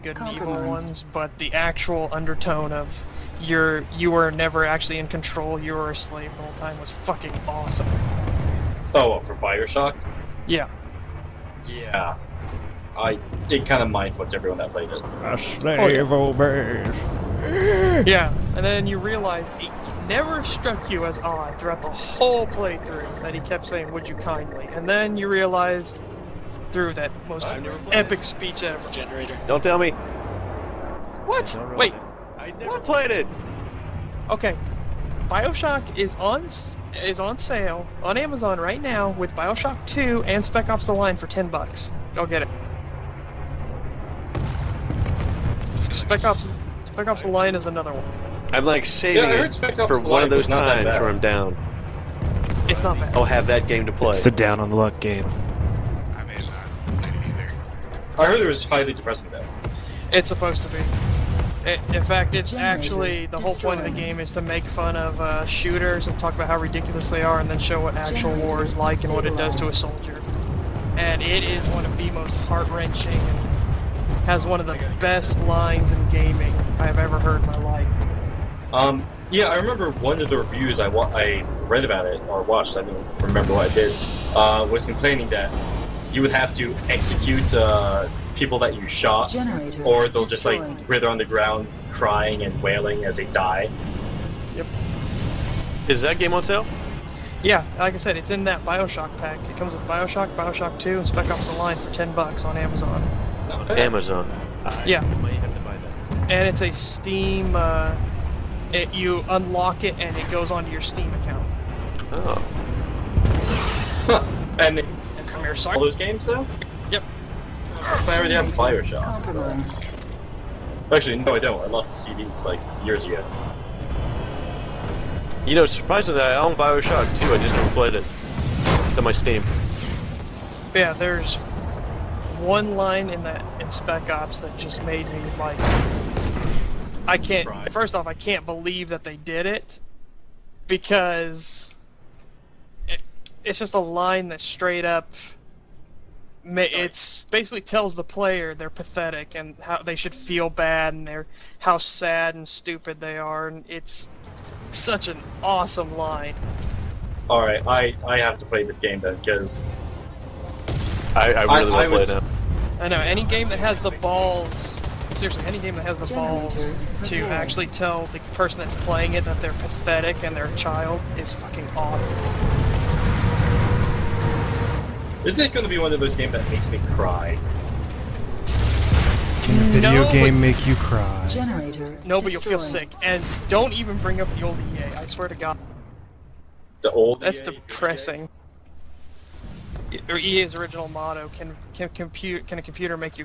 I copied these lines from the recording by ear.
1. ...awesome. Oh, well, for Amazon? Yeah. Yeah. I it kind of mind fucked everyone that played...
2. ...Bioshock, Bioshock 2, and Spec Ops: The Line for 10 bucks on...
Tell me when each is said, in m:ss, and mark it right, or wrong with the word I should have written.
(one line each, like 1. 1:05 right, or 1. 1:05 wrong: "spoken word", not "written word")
1. 0:07 wrong: "Bioshock", not "Amazon"
2. 1:39 right.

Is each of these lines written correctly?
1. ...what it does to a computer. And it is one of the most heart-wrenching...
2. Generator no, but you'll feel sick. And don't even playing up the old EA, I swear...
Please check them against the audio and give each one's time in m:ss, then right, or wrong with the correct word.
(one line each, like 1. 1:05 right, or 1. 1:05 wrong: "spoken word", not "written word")
1. 1:09 wrong: "soldier", not "computer"
2. 3:01 wrong: "bring", not "playing".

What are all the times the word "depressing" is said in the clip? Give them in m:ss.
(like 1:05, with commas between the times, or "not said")
0:58, 3:07.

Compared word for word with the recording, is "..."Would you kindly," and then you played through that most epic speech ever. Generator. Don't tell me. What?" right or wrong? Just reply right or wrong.
wrong.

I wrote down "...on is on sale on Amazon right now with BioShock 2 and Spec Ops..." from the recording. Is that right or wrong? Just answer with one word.
right.